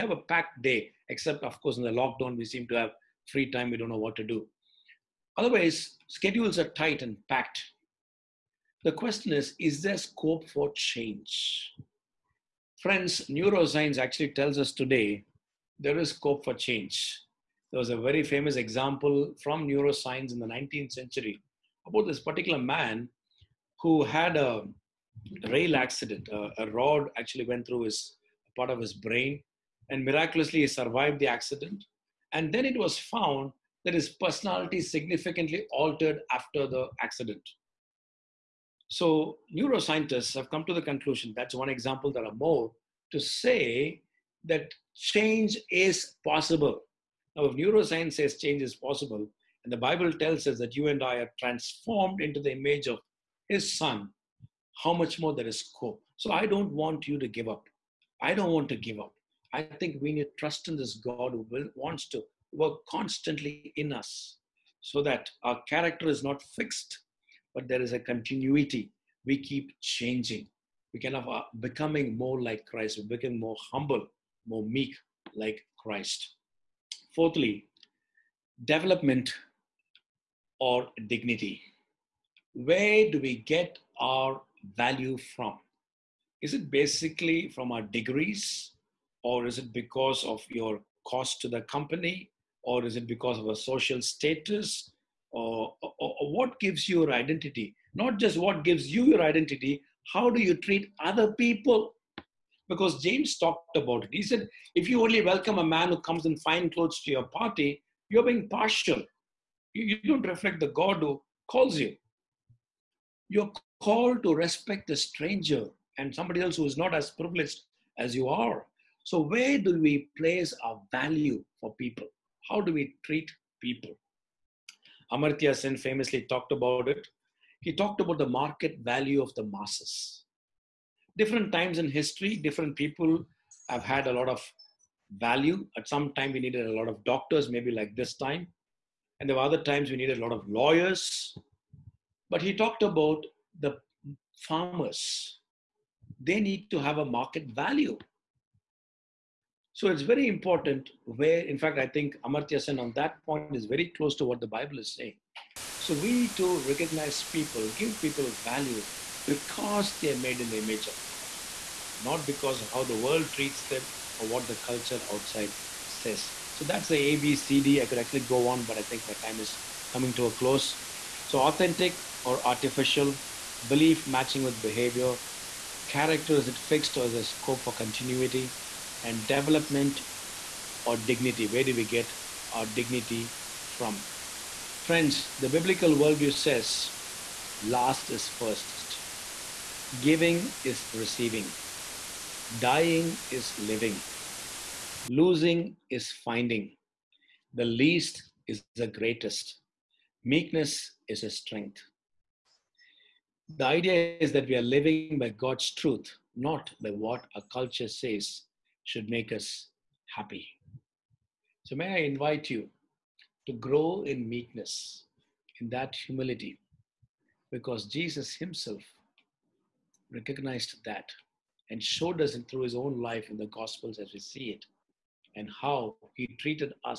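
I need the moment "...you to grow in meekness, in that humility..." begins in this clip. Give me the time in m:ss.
3:32.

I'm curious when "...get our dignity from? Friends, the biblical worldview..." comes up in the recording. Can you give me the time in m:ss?
3:01.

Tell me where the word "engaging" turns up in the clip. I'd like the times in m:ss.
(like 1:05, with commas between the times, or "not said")
not said.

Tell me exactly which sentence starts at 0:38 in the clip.
So neuroscientists have come to the conclusion, that's one example, there are more, to say that change is possible.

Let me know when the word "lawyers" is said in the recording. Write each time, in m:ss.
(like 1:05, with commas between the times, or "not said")
2:20.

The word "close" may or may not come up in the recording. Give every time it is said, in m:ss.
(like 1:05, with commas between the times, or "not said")
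2:33, 2:50.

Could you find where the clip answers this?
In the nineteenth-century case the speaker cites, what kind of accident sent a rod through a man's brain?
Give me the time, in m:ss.
0:25.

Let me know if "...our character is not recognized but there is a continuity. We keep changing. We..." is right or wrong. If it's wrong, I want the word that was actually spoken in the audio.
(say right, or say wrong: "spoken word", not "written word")
wrong: "fixed", not "recognized".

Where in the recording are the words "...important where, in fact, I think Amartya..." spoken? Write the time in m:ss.
2:30.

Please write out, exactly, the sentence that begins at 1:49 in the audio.
You, you don't reflect the God who calls you.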